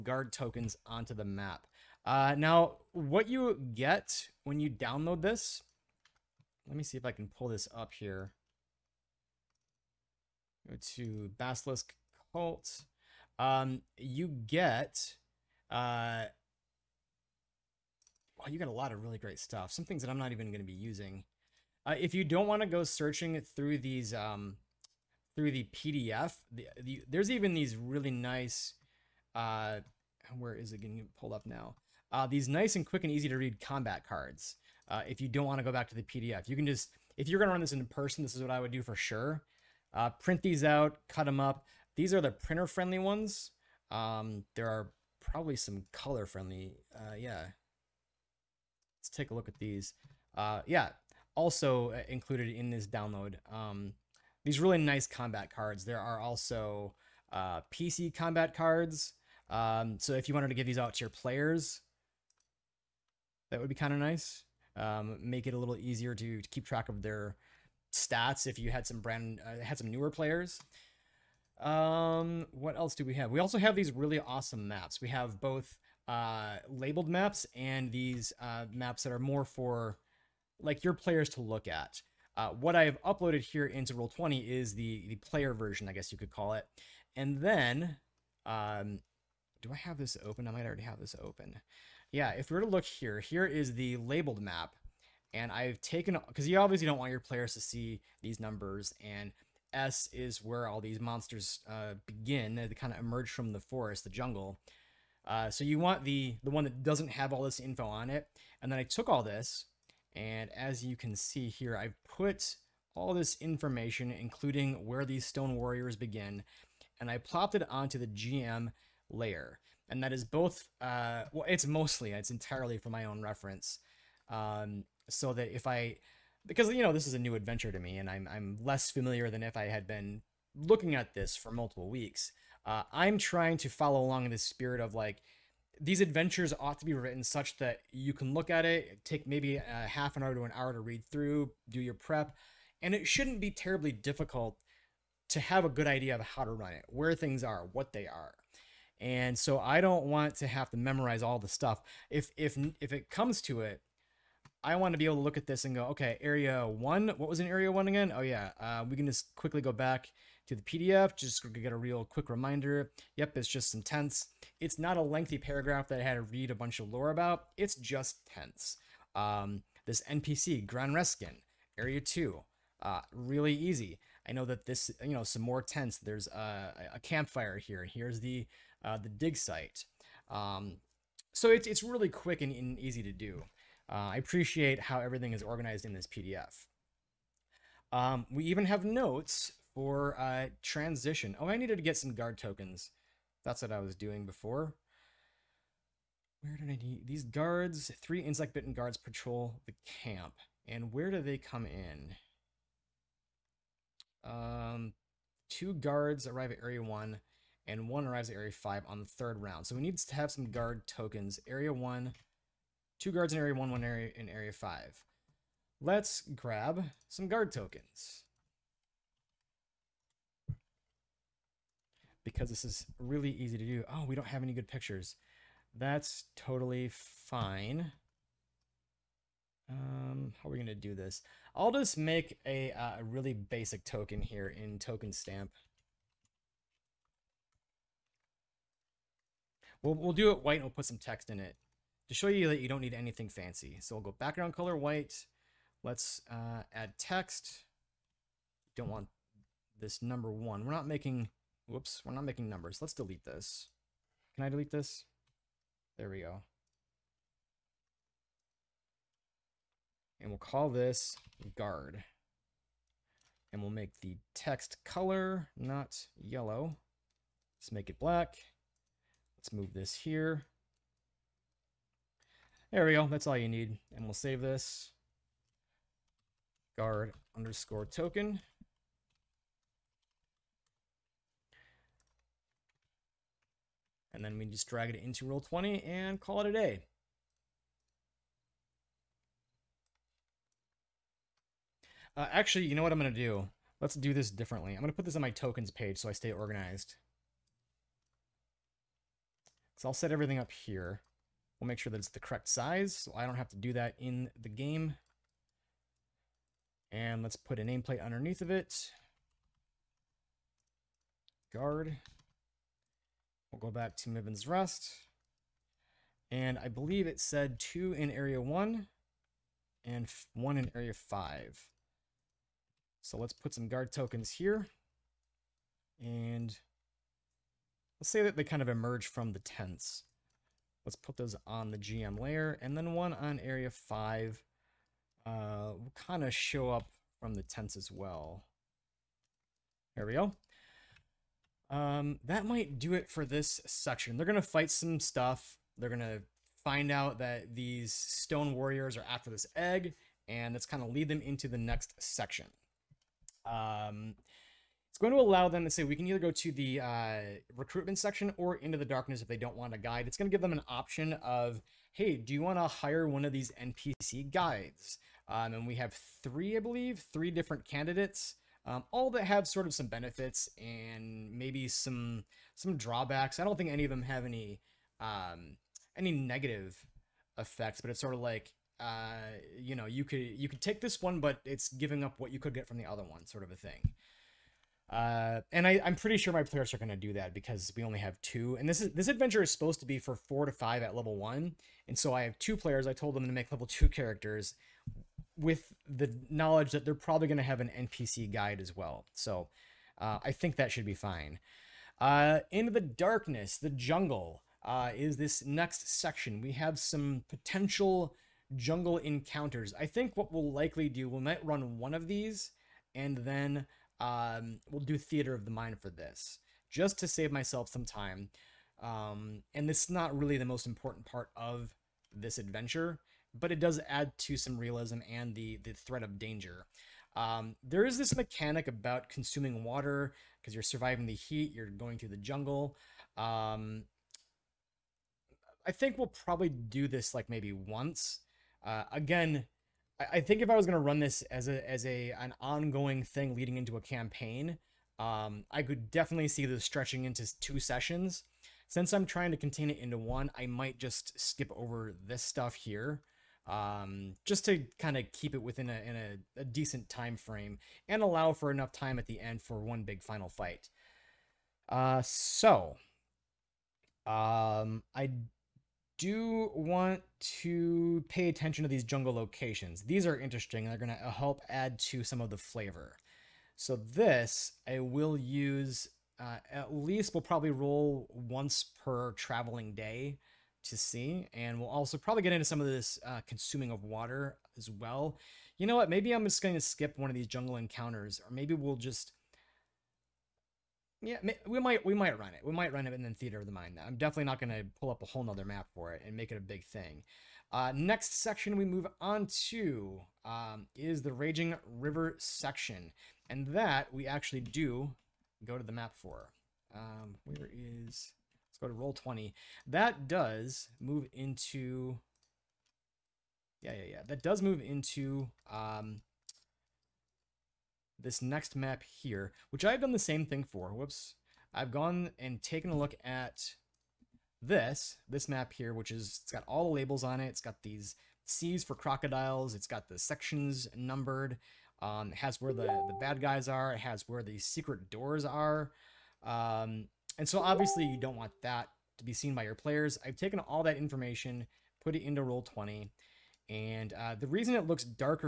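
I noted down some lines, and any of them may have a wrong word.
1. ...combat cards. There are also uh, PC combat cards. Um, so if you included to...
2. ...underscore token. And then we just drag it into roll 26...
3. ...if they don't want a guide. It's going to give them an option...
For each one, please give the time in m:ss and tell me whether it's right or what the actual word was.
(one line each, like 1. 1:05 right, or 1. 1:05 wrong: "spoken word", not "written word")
1. 0:55 wrong: "wanted", not "included"
2. 4:37 wrong: "20", not "26"
3. 5:59 right.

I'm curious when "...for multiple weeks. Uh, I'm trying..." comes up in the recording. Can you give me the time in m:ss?
2:11.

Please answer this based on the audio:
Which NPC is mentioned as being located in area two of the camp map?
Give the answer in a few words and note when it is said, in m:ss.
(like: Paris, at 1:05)
Gran Reskin, at 2:50.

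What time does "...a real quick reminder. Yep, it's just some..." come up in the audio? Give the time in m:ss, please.
2:41.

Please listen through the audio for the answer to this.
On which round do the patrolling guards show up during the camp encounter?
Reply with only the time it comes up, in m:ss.
3:29.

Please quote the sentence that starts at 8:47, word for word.
It's got these C's for crocodiles.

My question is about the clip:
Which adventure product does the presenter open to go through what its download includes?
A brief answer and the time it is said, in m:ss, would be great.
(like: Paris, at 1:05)
Basilisk Cult, at 0:11.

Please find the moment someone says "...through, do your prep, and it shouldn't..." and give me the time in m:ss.
2:21.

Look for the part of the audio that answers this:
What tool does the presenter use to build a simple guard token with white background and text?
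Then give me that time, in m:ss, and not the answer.
3:54.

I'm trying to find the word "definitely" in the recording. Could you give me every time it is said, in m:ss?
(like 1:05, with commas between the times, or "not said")
7:25, 8:13.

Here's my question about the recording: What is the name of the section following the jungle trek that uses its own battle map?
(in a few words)
Raging River.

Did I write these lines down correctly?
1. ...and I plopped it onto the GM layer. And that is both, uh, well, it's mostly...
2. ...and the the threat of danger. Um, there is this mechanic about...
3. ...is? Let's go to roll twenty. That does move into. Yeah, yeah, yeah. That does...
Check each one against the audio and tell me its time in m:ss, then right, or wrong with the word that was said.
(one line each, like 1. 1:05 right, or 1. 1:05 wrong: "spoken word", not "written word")
1. 1:56 right
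2. 7:05 right
3. 8:27 right.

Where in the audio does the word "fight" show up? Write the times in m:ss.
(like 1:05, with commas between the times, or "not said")
5:44, 7:40.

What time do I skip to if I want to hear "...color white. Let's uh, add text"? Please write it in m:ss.
4:04.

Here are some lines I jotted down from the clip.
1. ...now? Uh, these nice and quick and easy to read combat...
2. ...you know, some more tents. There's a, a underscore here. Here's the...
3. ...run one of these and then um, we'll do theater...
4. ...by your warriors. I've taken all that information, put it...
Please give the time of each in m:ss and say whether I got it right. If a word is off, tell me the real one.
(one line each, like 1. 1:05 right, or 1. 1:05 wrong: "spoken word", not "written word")
1. 0:31 right
2. 2:55 wrong: "campfire", not "underscore"
3. 6:51 right
4. 8:59 wrong: "players", not "warriors".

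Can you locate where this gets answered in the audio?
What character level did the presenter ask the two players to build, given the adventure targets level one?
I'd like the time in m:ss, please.
6:33.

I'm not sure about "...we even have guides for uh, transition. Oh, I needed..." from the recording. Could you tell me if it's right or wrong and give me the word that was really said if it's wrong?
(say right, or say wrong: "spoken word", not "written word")
wrong: "notes", not "guides".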